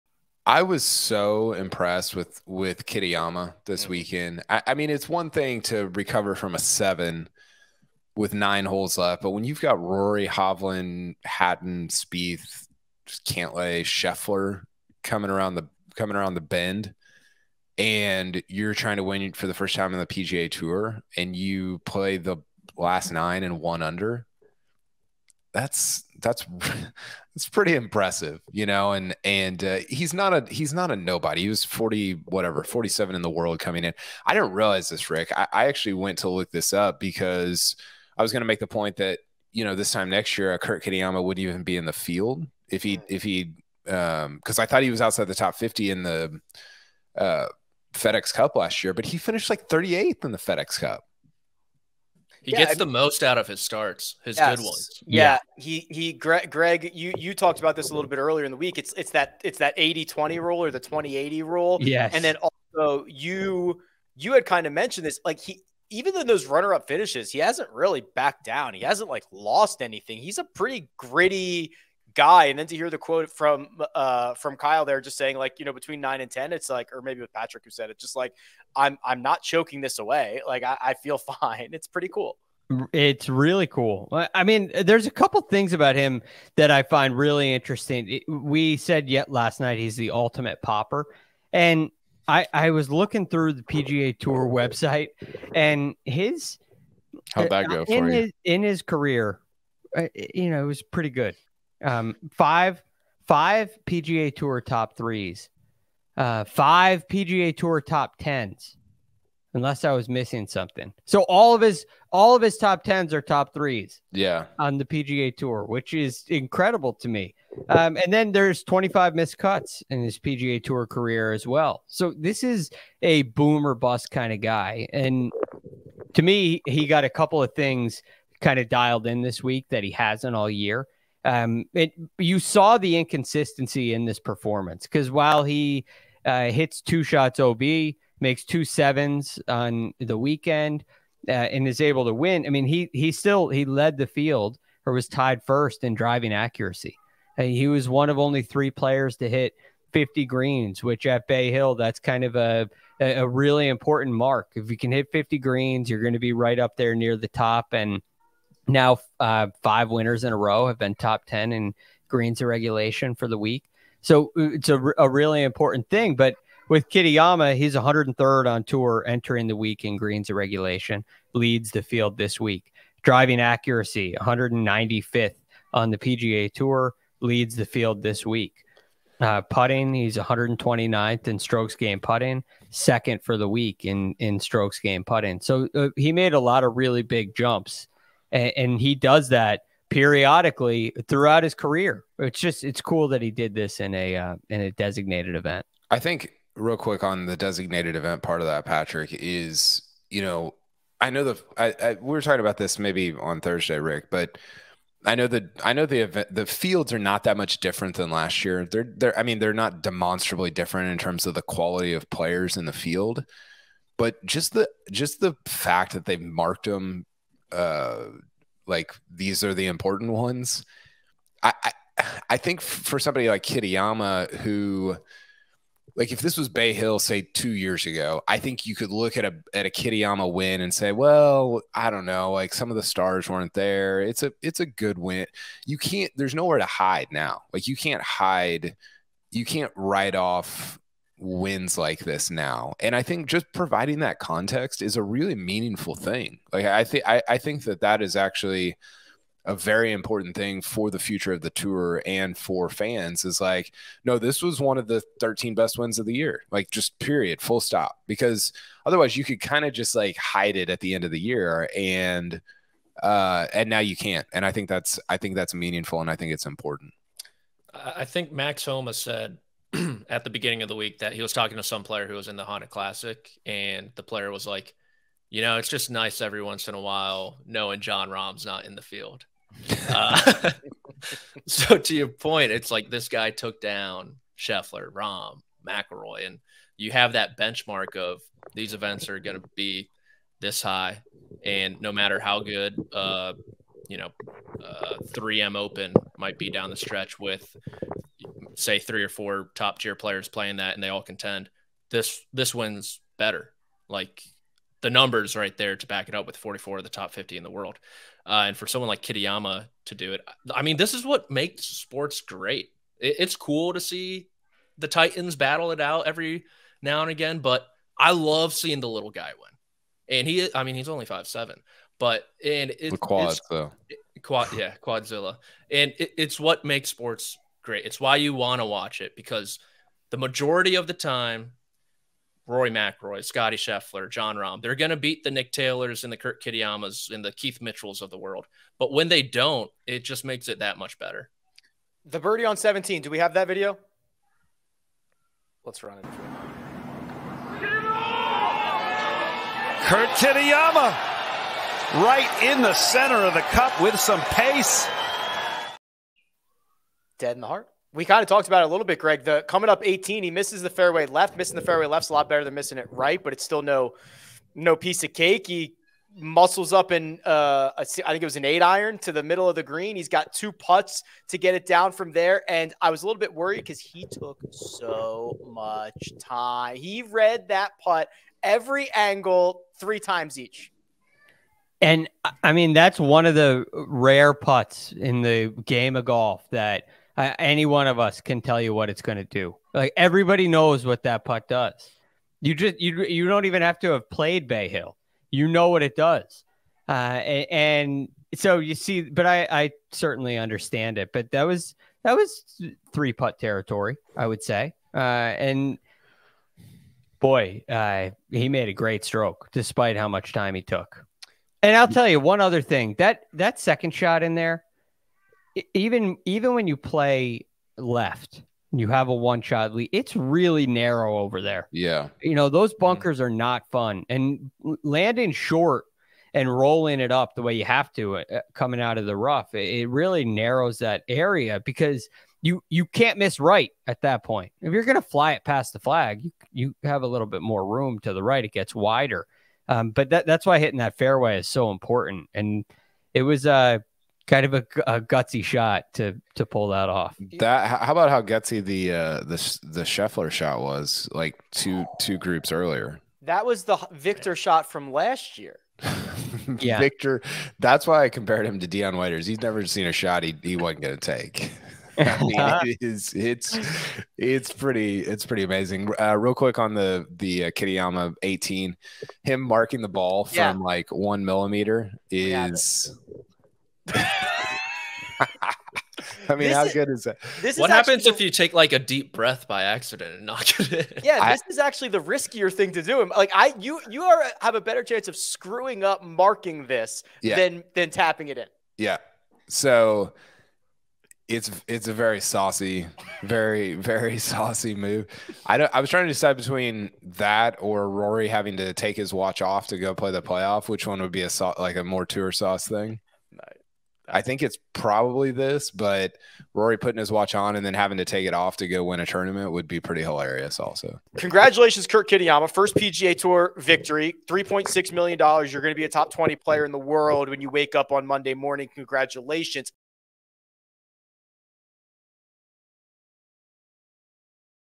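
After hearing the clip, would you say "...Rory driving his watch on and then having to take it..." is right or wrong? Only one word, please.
wrong.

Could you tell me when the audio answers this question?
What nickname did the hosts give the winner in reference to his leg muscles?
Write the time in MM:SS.
05:24.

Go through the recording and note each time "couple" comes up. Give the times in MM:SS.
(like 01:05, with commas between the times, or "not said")
01:25, 02:07.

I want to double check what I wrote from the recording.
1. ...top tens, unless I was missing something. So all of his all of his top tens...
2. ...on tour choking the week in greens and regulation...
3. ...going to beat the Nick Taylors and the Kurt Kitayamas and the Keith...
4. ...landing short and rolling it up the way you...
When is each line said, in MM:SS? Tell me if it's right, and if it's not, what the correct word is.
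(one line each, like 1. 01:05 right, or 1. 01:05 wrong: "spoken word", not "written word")
1. 01:47 right
2. 02:48 wrong: "entering", not "choking"
3. 05:34 right
4. 07:04 right.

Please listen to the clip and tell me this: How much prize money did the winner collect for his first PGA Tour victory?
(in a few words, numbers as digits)
$3.6 million.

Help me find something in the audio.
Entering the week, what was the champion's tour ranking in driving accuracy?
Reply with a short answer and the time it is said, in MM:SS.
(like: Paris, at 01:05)
195th, at 02:54.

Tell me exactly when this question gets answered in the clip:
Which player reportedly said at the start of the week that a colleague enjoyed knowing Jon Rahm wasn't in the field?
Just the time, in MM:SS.
04:28.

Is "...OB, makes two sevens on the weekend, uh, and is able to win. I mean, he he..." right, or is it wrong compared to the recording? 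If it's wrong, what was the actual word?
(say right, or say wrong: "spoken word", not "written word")
right.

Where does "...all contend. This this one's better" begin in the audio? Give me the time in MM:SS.
05:00.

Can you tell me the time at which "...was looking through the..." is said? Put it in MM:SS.
01:32.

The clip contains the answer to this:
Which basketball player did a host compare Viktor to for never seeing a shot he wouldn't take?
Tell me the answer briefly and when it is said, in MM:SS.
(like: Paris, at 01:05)
Dion Waiters, at 07:38.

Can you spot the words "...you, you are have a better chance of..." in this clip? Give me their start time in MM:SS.
08:03.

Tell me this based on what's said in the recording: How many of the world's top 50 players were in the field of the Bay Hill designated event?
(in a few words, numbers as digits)
44.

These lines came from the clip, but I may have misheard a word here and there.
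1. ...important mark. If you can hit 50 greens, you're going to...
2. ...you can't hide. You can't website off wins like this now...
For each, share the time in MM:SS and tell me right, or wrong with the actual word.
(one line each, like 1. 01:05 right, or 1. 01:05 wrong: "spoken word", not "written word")
1. 02:33 right
2. 03:57 wrong: "write", not "website".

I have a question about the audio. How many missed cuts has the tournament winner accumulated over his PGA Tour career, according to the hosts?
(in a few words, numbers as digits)
25.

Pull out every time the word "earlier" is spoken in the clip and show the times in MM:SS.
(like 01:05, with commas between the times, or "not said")
00:58, 07:32.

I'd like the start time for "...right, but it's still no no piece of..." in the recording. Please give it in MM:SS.
06:02.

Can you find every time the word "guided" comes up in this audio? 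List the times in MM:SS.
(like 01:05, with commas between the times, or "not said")
not said.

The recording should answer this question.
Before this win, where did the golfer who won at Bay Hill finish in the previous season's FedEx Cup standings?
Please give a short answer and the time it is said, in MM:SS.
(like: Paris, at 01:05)
38th, at 00:49.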